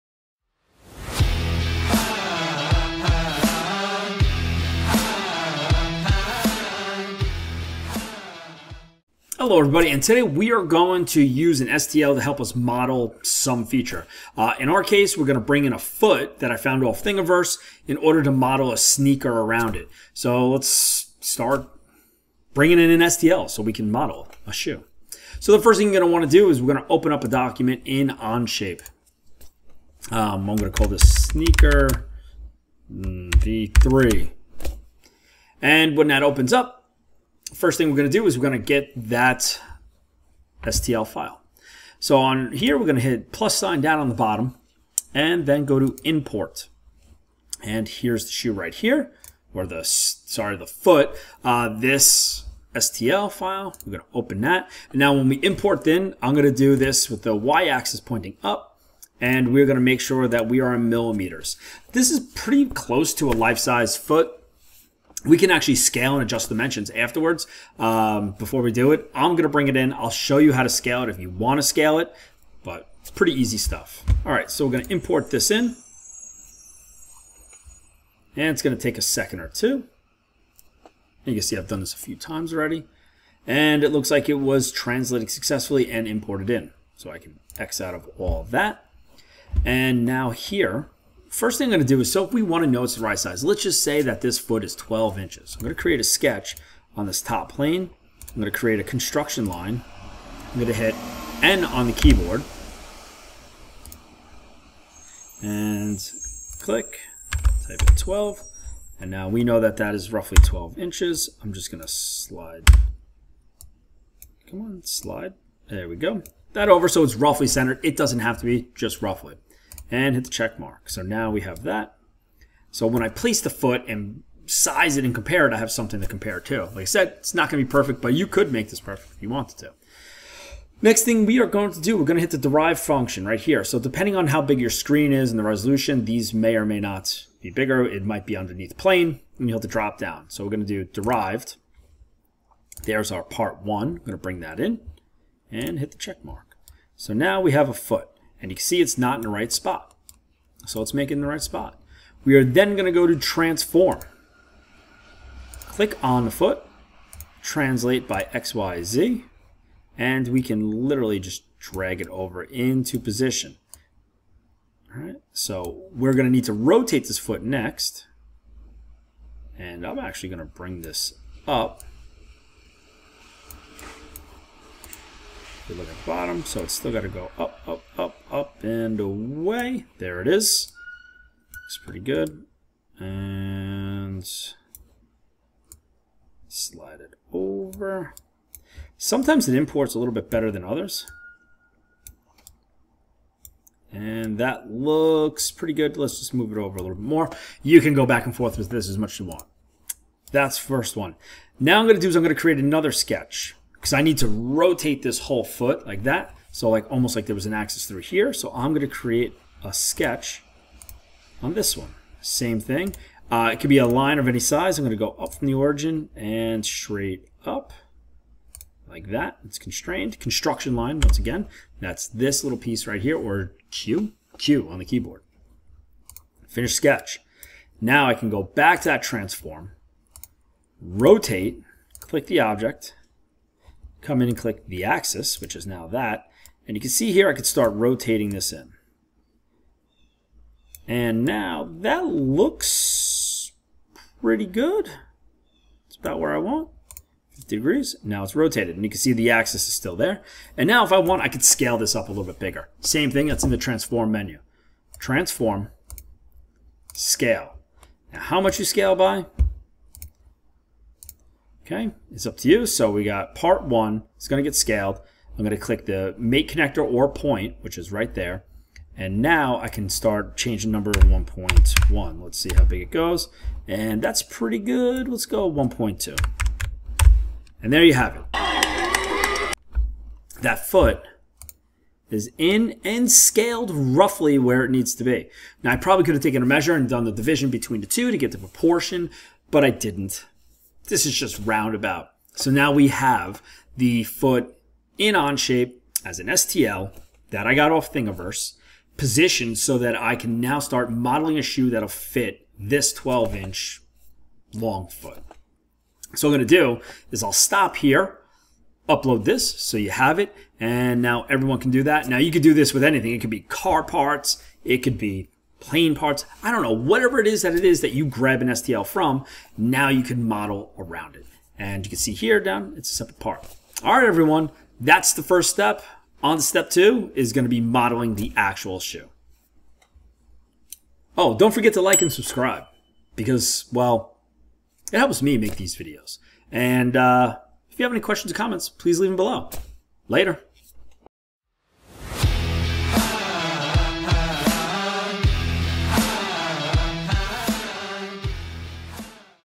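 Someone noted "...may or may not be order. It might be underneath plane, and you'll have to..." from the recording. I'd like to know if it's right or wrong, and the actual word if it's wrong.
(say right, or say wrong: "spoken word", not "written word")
wrong: "bigger", not "order".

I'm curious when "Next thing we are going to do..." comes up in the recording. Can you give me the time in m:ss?
2:10.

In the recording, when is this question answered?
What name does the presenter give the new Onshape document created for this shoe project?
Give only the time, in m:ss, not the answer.
0:31.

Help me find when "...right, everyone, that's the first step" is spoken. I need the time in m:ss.
5:23.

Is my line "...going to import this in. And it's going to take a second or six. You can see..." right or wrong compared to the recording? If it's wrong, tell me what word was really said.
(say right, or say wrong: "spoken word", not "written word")
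wrong: "two", not "six".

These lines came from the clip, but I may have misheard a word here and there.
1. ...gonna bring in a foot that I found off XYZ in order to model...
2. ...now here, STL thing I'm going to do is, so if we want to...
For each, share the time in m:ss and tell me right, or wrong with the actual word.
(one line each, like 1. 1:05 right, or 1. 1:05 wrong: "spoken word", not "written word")
1. 0:15 wrong: "Thingiverse", not "XYZ"
2. 1:30 wrong: "First", not "STL".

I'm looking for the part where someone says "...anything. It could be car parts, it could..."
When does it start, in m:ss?
5:12.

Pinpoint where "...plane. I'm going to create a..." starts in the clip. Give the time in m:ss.
1:37.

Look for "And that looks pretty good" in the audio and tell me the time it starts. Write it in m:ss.
3:13.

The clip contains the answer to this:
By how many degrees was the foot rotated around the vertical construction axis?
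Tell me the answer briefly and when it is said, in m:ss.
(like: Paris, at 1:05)
50, at 4:07.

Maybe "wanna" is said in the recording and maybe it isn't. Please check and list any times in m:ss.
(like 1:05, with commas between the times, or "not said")
0:26.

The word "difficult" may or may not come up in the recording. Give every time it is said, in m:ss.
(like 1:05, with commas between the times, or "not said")
not said.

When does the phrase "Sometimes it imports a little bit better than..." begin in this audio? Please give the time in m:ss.
3:08.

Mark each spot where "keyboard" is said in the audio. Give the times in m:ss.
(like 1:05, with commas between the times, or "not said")
1:41, 3:44.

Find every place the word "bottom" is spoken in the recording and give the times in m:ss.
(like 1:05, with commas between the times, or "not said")
0:44, 2:56.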